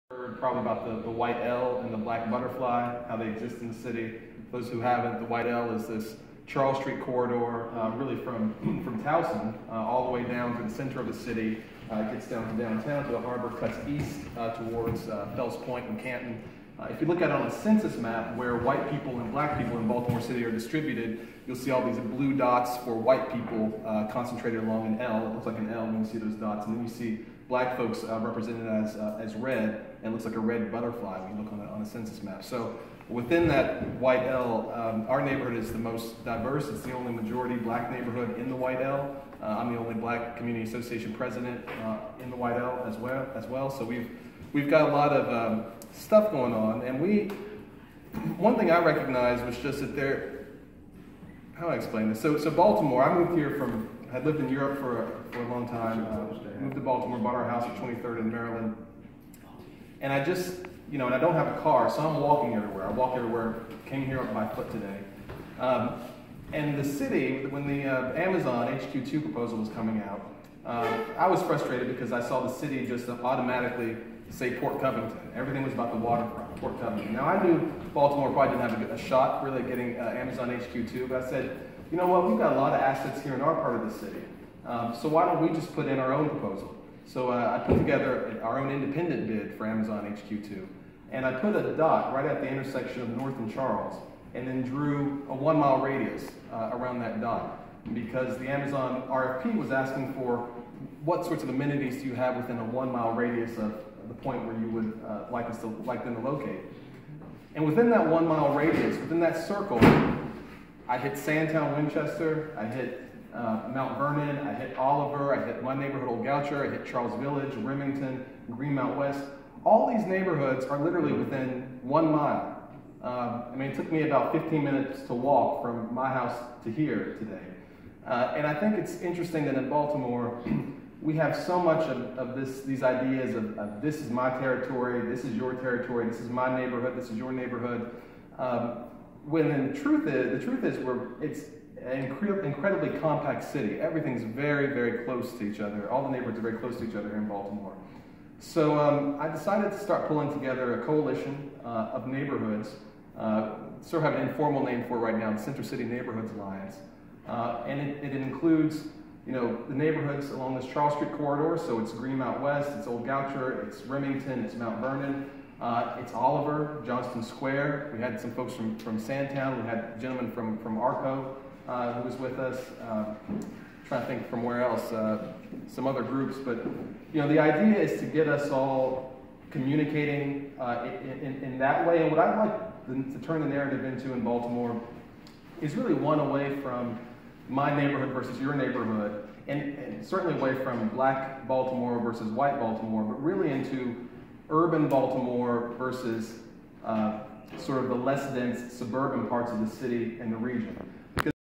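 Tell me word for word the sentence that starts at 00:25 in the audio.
It looks like an L when you see those dots.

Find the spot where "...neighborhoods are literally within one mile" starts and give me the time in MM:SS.
02:00.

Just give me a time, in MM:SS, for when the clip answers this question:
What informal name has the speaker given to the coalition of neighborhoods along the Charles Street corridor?
02:35.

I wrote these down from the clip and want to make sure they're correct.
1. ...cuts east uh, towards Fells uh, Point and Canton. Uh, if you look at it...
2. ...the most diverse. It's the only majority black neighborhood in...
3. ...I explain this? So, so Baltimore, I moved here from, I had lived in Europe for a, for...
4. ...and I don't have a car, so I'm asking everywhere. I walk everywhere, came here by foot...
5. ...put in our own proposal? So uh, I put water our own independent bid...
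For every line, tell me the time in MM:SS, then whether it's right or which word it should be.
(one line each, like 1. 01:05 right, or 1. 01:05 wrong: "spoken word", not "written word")
1. 00:13 right
2. 00:35 right
3. 00:51 right
4. 01:01 wrong: "walking", not "asking"
5. 01:25 wrong: "together", not "water".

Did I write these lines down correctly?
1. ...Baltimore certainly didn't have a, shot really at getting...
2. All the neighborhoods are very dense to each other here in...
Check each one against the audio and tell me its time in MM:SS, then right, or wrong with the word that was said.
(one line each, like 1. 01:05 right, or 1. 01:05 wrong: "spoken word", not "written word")
1. 01:17 wrong: "probably", not "certainly"
2. 02:25 wrong: "close", not "dense".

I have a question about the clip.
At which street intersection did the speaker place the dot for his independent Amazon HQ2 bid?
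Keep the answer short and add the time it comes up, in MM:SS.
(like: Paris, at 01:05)
North and Charles, at 01:33.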